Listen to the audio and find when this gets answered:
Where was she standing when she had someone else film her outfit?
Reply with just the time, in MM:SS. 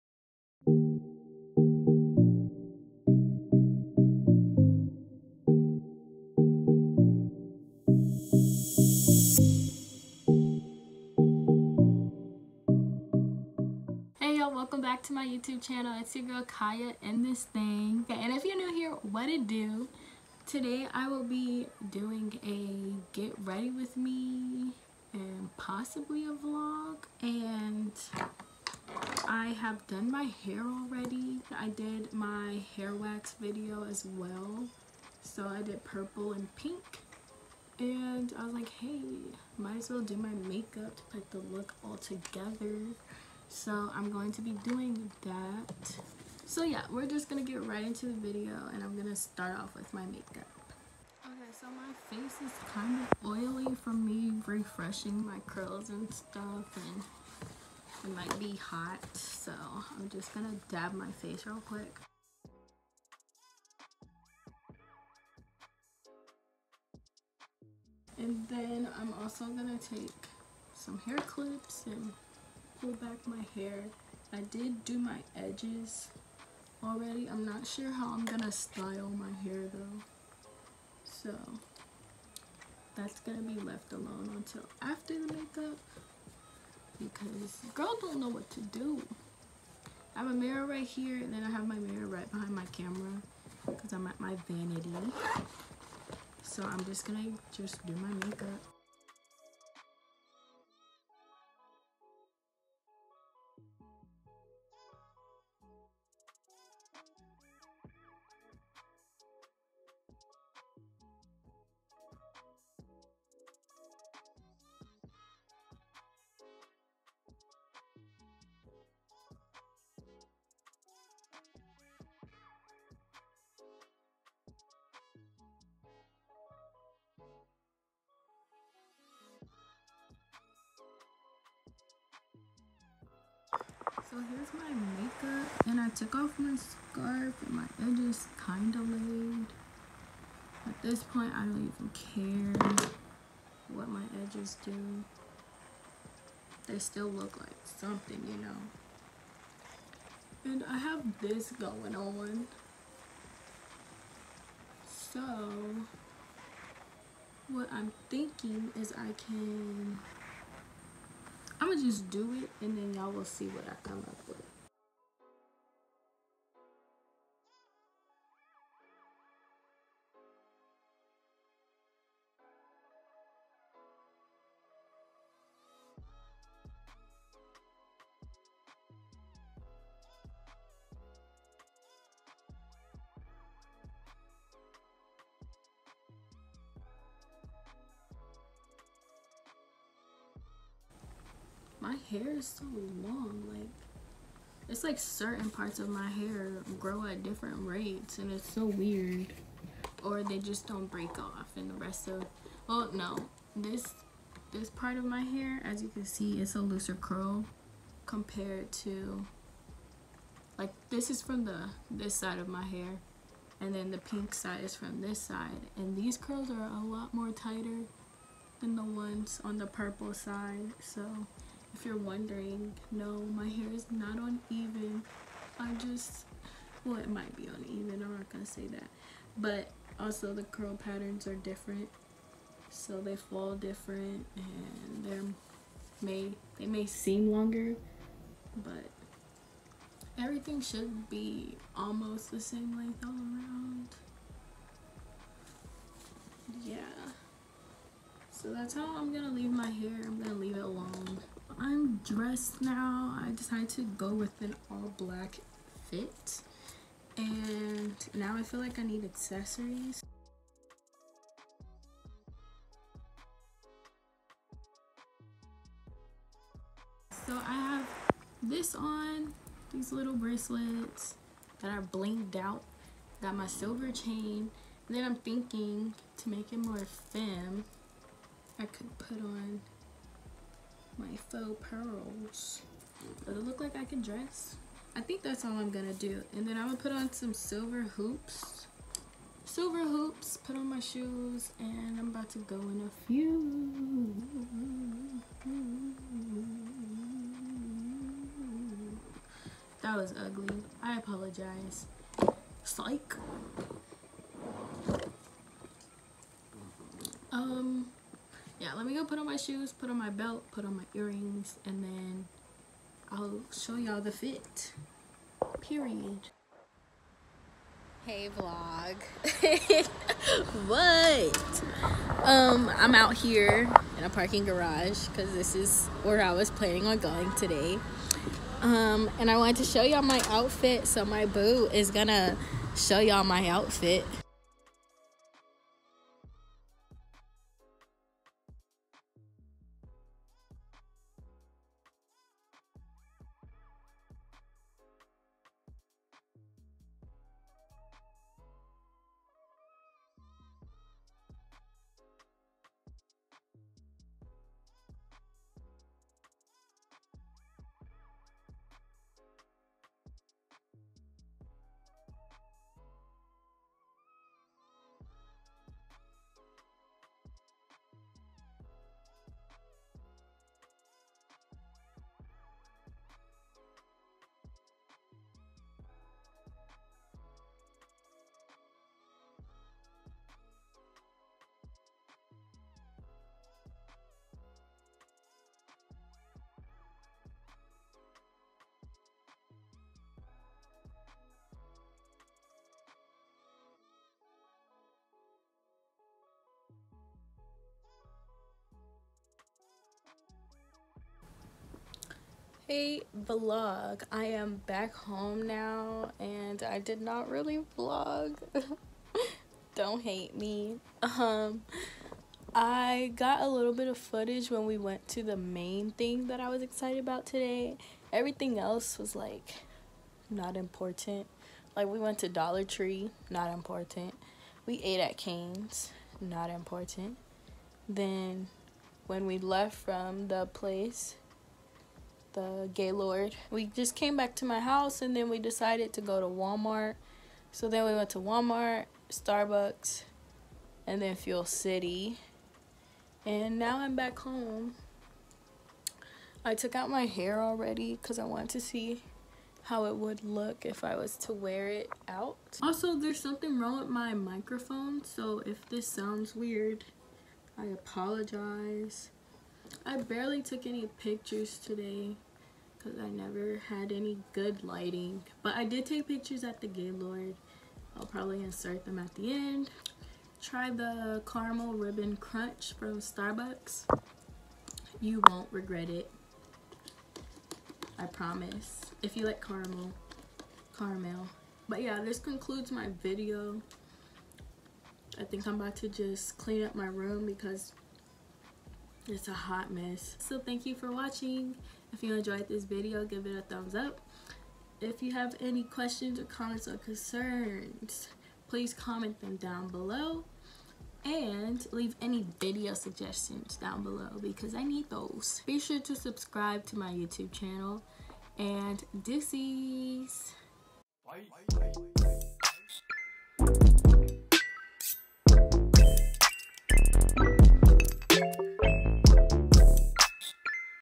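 05:24.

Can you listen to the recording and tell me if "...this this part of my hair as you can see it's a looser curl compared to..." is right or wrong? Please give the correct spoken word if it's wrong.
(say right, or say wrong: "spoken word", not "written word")
right.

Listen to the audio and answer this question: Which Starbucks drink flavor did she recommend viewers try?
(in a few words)
Caramel ribbon crunch.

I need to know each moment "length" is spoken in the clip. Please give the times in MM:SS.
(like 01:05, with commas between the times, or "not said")
04:02.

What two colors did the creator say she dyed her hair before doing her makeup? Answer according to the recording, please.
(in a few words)
Purple and pink.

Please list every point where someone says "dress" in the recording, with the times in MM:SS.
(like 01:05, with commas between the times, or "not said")
04:12, 04:44.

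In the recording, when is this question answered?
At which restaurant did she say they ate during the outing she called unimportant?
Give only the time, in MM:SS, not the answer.
07:05.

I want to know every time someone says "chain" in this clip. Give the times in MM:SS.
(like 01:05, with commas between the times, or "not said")
04:33.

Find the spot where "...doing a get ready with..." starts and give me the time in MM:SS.
00:21.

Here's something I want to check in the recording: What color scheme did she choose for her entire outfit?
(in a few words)
All black.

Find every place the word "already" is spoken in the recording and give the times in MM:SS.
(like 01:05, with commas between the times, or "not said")
00:30, 01:16, 07:27.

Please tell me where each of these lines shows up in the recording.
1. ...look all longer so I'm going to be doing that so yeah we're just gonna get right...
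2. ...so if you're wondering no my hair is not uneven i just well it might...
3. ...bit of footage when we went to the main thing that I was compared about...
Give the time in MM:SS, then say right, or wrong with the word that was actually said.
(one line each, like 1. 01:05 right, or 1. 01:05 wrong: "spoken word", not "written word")
1. 00:41 wrong: "together", not "longer"
2. 03:40 right
3. 06:53 wrong: "excited", not "compared".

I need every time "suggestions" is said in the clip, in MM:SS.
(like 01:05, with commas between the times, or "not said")
08:22.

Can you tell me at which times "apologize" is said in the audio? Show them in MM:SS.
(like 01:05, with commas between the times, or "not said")
05:00, 07:37.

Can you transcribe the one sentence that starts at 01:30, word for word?
I have a mirror right here and then I have my mirror right behind my camera because I'm at my vanity.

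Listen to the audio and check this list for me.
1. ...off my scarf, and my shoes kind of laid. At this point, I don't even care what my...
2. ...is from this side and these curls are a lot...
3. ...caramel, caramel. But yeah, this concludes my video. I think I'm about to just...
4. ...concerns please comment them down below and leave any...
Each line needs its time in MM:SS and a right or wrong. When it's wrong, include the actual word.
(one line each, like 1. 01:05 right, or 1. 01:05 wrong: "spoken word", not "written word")
1. 02:16 wrong: "edges", not "shoes"
2. 03:34 right
3. 07:59 right
4. 08:16 right.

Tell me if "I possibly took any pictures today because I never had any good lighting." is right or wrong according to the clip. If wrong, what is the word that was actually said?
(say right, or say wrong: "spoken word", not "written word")
wrong: "barely", not "possibly".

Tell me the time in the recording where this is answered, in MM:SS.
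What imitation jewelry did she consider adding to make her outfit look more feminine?
04:41.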